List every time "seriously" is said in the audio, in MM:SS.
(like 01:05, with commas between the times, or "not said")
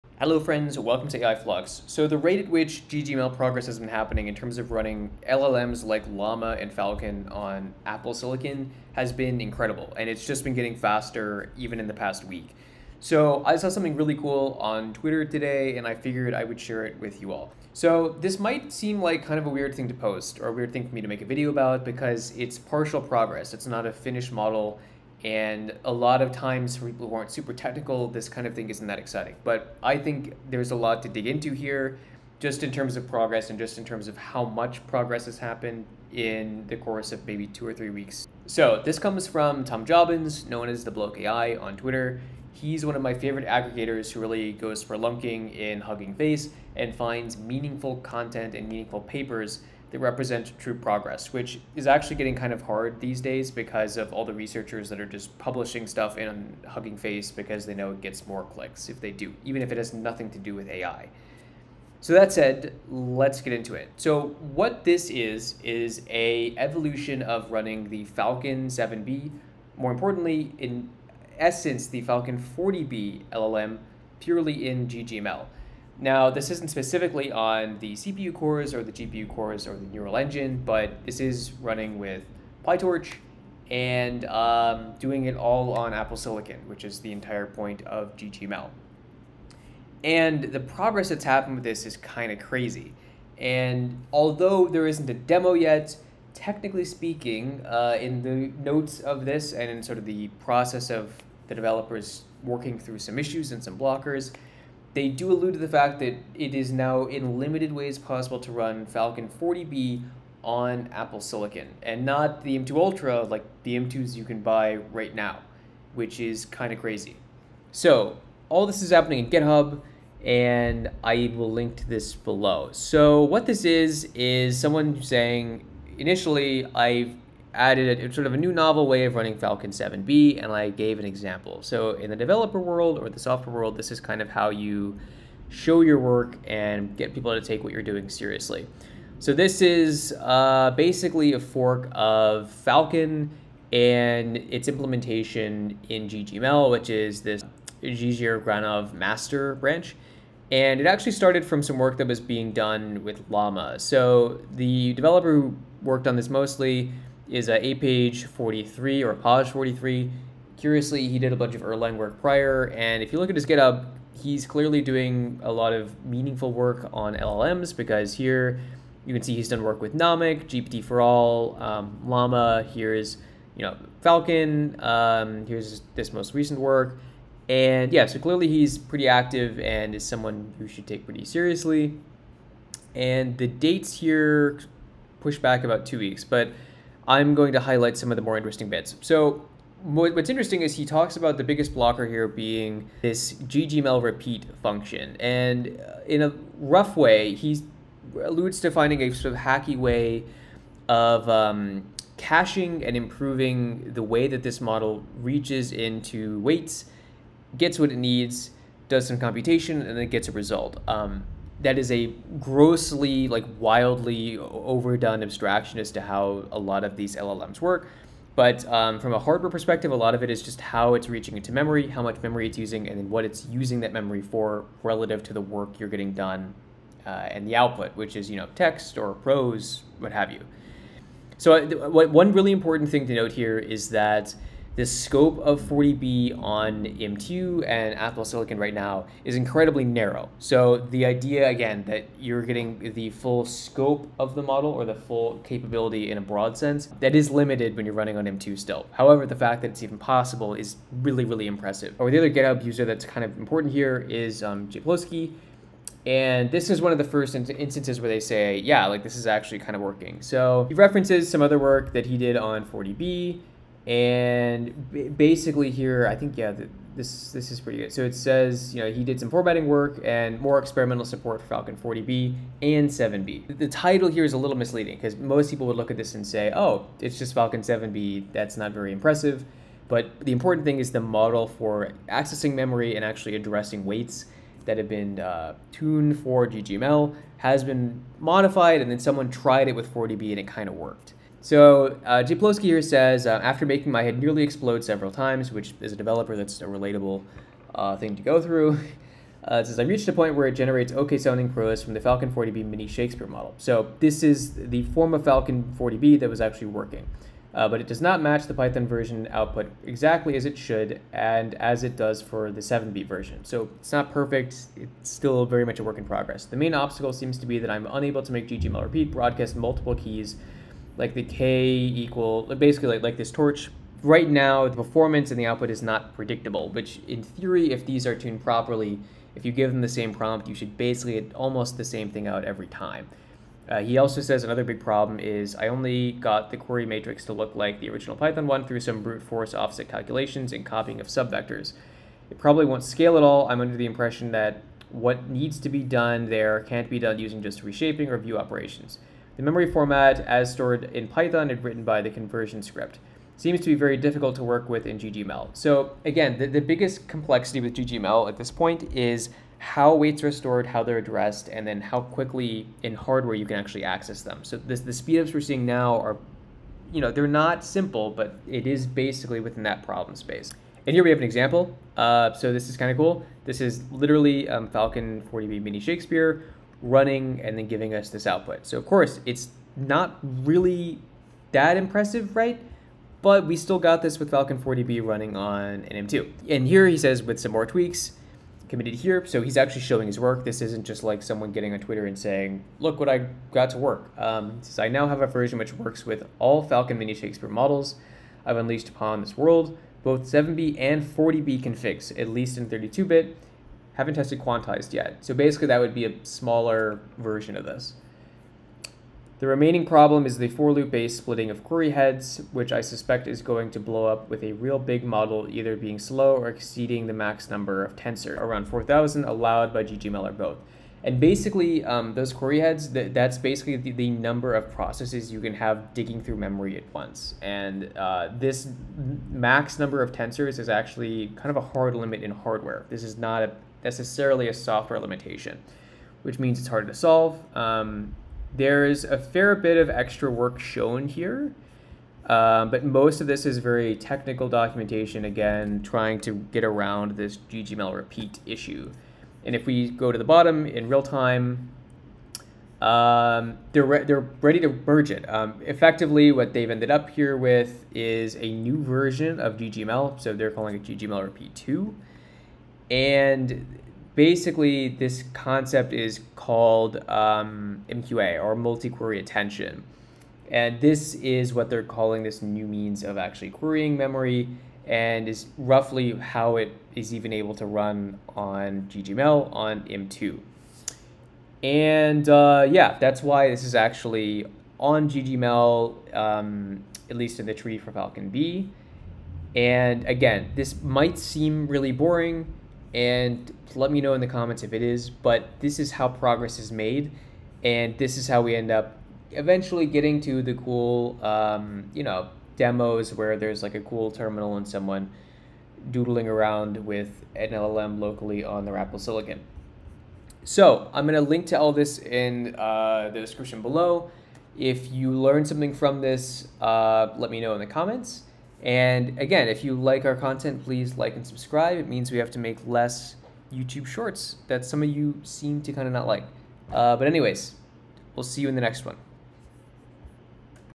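02:18, 03:01.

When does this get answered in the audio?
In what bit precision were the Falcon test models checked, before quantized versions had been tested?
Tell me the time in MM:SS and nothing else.
06:42.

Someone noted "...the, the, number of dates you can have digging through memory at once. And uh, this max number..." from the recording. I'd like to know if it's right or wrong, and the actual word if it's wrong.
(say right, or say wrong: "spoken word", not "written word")
wrong: "processes", not "dates".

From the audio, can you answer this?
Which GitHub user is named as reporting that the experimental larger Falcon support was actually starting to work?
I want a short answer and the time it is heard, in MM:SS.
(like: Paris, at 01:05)
Jan Ploski, at 04:14.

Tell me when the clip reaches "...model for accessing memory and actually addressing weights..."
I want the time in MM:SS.
04:41.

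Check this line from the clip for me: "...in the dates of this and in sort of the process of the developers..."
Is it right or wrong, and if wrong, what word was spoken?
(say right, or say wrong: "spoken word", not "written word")
wrong: "notes", not "dates".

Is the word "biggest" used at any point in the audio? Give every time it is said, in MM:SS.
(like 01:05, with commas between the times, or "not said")
03:11, 05:56.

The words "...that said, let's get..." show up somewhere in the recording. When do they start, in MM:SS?
01:02.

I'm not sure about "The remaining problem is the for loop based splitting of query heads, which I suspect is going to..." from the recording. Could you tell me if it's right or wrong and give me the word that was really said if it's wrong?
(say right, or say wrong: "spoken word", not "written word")
right.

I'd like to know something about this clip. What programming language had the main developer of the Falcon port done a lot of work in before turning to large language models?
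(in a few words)
Erlang.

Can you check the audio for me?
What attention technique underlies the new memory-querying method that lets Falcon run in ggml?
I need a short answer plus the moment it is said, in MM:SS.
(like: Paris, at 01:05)
multi-query attention, at 07:47.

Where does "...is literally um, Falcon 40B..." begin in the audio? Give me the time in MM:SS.
06:13.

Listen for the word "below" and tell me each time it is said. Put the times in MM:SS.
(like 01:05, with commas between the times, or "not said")
02:02, 08:33.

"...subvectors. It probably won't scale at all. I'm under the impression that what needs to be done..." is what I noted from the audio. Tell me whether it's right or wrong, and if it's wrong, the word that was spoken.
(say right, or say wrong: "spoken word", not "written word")
right.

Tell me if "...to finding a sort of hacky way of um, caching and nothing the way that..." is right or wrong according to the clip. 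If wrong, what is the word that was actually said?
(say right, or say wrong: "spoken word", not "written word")
wrong: "improving", not "nothing".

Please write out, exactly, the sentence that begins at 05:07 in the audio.
Uh, but it does not match the Python version output exactly as it should and as it does for the 7B version.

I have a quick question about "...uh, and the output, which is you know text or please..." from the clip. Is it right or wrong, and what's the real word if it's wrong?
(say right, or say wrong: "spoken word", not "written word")
wrong: "prose", not "please".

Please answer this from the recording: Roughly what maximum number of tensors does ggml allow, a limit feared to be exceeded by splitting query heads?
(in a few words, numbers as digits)
4,000.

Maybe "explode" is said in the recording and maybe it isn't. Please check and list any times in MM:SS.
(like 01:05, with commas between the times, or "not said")
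04:54.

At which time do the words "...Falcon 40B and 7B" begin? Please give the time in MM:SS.
04:31.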